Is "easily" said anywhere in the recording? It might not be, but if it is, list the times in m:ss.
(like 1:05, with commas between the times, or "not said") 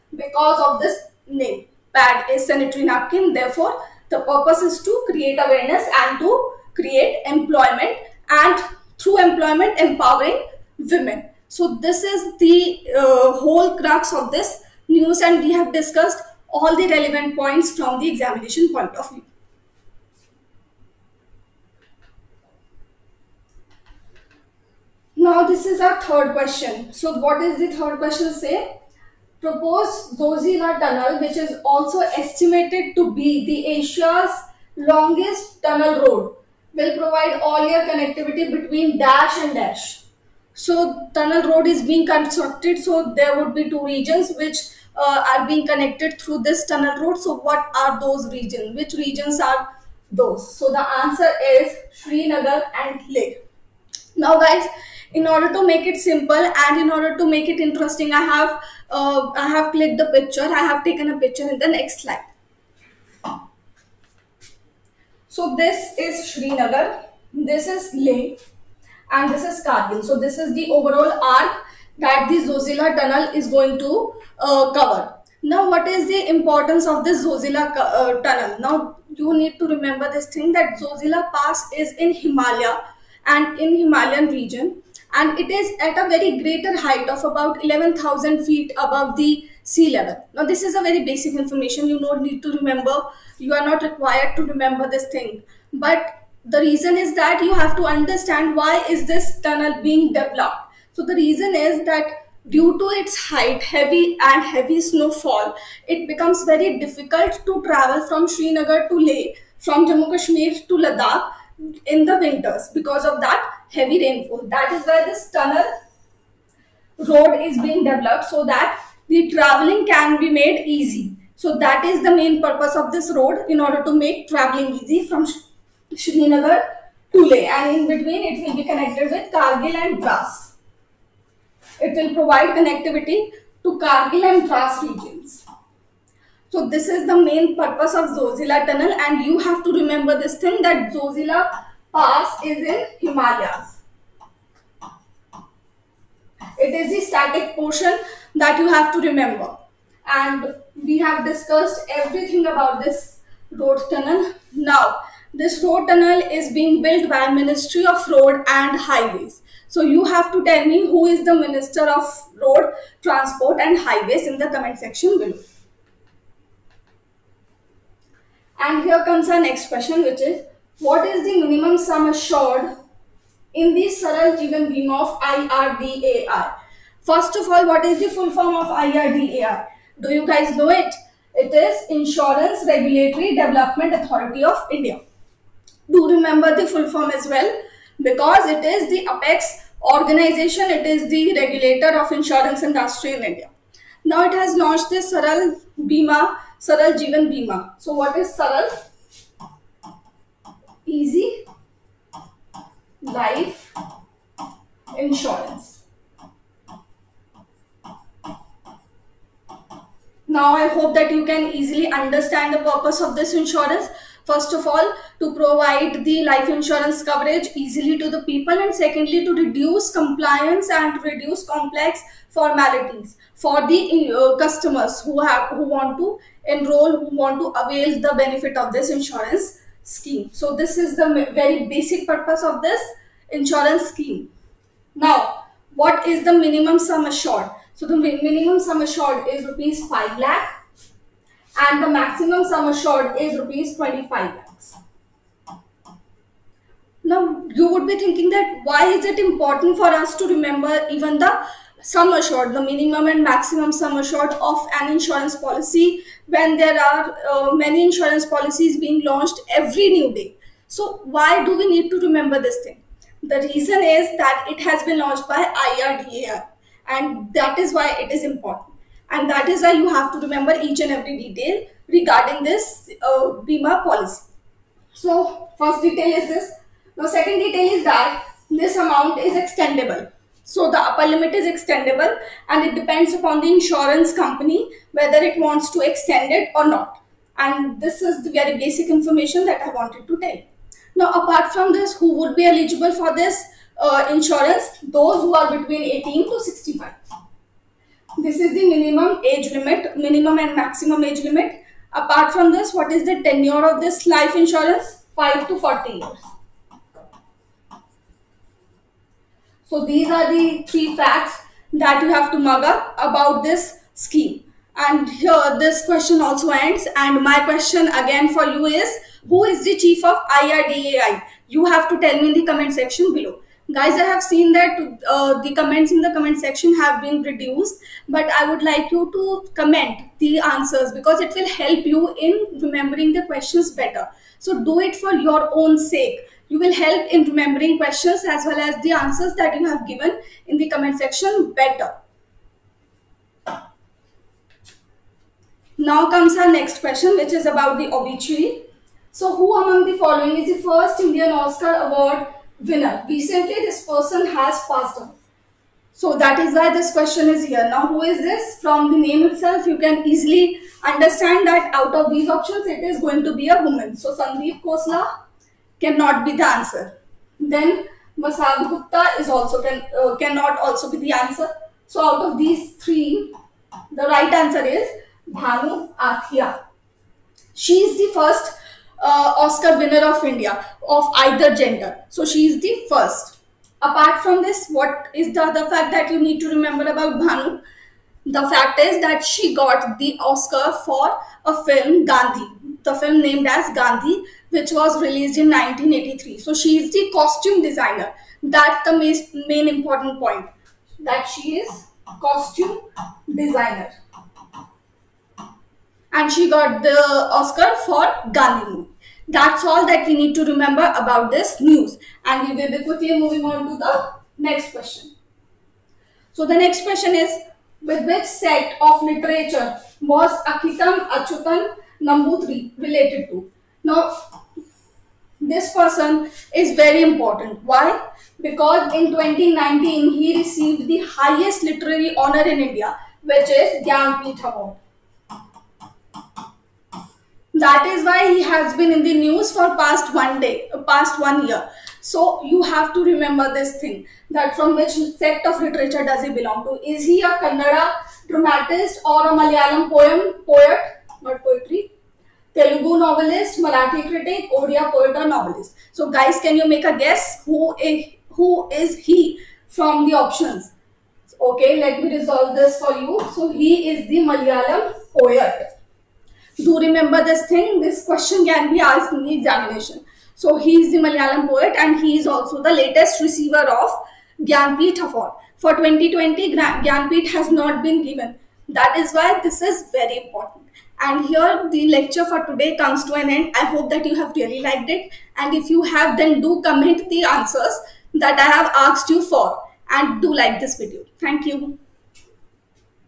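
3:31, 3:37, 6:00.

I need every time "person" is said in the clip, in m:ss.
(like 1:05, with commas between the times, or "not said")
5:53, 7:05.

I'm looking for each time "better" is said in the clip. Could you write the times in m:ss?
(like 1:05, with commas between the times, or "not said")
5:33, 5:41.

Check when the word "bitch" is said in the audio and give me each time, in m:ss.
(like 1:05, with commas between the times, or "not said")
not said.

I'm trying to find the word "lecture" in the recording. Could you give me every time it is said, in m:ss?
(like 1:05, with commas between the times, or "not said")
8:01.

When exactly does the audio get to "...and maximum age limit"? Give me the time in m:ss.
5:00.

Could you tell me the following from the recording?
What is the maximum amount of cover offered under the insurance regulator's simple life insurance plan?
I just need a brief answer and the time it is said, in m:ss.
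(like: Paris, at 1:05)
25 lakhs, at 4:03.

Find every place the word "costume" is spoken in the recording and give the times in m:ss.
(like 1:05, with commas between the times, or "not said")
6:37, 6:42.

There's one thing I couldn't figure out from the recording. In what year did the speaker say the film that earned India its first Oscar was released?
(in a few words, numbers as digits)
1983.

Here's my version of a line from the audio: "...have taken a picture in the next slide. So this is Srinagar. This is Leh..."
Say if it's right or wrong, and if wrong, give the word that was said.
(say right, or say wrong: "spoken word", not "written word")
right.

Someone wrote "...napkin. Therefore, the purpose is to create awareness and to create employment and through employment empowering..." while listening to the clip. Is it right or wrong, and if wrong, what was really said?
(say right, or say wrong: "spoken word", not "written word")
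right.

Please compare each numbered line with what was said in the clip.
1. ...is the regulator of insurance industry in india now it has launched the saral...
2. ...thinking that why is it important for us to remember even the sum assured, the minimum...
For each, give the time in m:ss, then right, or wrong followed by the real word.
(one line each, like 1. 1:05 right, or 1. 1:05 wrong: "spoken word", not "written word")
1. 3:10 right
2. 4:07 right.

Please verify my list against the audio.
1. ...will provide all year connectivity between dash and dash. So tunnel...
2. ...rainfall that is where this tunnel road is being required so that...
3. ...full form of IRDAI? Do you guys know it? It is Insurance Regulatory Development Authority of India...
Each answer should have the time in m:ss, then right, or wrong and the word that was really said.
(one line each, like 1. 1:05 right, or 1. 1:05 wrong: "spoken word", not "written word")
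1. 0:36 right
2. 1:54 wrong: "developed", not "required"
3. 2:58 right.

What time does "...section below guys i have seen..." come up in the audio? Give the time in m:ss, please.
5:22.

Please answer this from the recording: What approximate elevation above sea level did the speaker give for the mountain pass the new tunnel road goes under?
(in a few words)
11,000 feet.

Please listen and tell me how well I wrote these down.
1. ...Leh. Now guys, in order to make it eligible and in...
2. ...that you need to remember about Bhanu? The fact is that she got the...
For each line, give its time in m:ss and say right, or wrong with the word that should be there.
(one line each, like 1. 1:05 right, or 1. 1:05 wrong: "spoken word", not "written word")
1. 0:53 wrong: "simple", not "eligible"
2. 6:25 right.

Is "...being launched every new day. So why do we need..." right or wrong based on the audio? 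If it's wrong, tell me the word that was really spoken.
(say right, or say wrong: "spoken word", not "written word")
right.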